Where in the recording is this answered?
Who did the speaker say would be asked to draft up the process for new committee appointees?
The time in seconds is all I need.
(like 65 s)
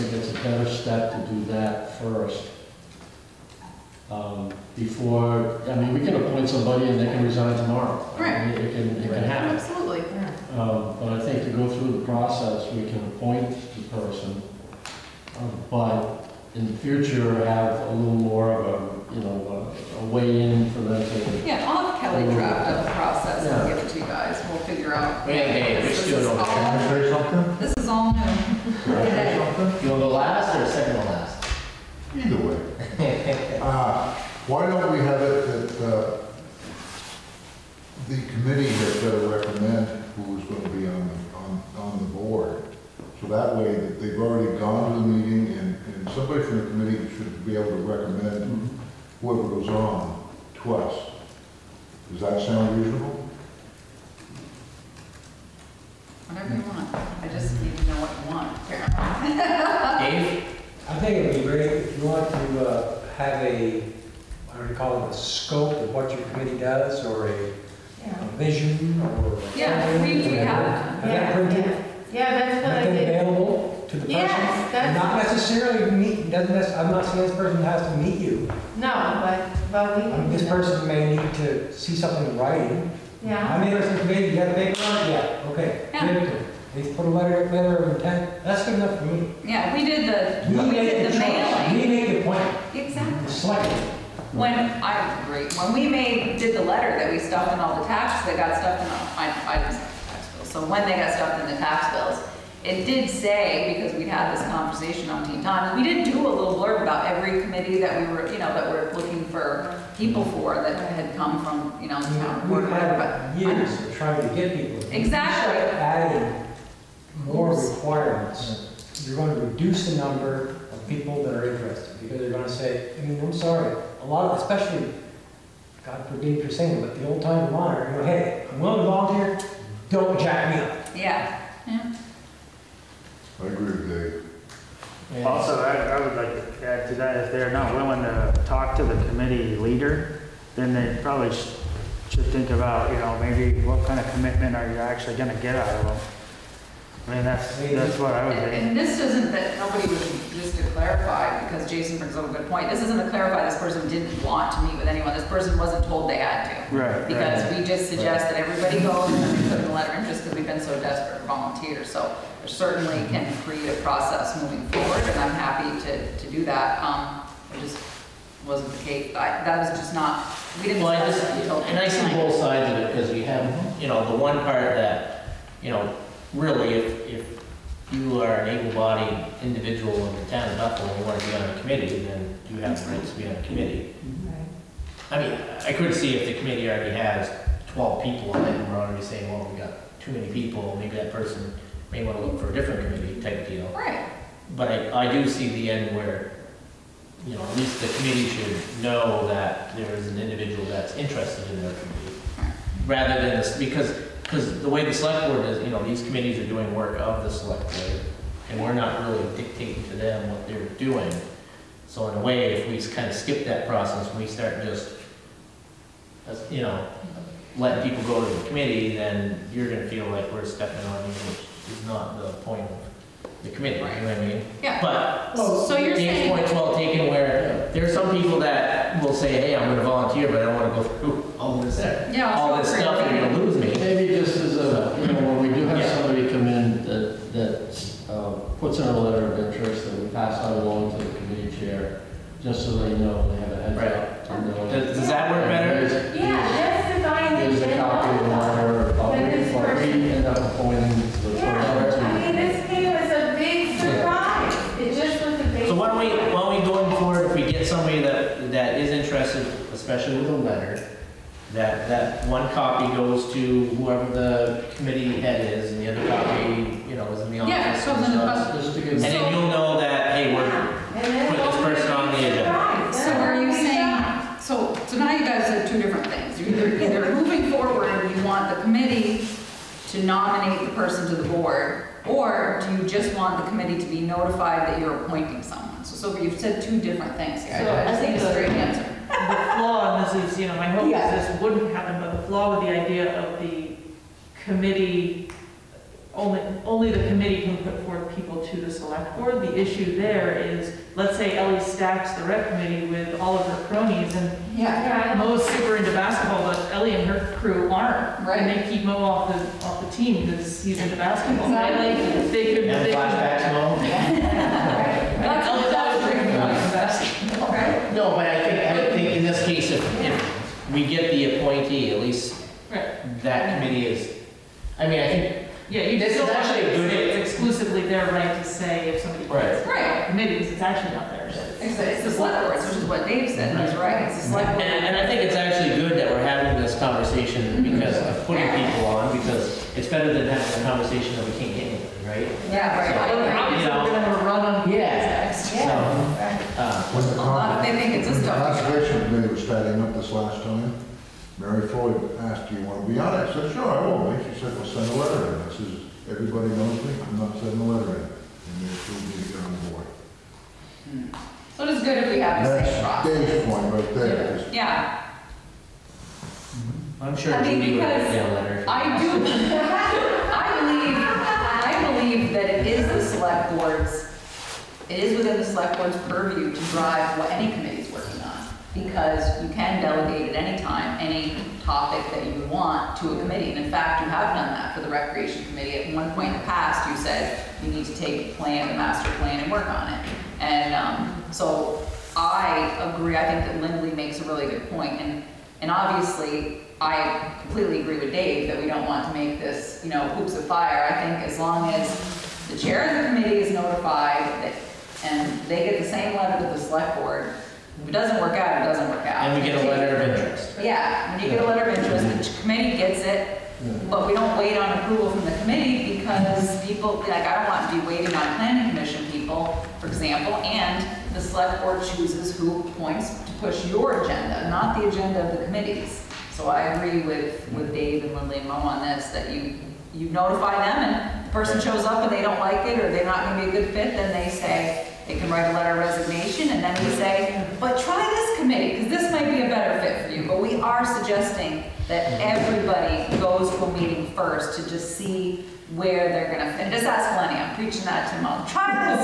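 21 s.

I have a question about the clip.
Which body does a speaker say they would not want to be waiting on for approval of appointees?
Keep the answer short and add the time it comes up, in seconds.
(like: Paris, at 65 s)
Planning commission, at 418 s.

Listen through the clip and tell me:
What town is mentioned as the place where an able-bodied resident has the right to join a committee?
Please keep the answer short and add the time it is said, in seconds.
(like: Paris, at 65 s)
Bethel, at 180 s.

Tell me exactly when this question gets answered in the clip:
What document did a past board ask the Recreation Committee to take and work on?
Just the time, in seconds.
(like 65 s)
388 s.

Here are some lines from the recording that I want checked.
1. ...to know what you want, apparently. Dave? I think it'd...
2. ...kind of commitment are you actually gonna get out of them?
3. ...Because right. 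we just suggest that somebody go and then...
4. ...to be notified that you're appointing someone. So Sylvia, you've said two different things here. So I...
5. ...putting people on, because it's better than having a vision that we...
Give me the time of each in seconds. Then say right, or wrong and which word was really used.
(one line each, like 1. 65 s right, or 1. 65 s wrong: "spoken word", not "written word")
1. 57 s right
2. 143 s right
3. 157 s wrong: "everybody", not "somebody"
4. 283 s right
5. 338 s wrong: "conversation", not "vision".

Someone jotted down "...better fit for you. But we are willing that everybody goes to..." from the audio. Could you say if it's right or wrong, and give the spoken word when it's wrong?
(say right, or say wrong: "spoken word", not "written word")
wrong: "suggesting", not "willing".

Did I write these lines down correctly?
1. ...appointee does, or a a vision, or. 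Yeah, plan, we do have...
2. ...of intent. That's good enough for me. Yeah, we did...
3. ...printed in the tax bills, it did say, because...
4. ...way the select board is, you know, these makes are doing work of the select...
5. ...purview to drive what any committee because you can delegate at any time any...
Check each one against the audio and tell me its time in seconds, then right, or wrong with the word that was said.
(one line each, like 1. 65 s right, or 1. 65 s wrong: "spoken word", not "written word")
1. 66 s wrong: "committee", not "appointee"
2. 87 s right
3. 101 s wrong: "stuffed", not "printed"
4. 204 s wrong: "committees", not "makes"
5. 376 s right.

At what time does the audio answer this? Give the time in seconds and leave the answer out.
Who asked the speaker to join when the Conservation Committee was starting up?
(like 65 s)
351 s.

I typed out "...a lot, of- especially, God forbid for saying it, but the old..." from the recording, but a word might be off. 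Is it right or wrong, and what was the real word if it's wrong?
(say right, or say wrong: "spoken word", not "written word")
right.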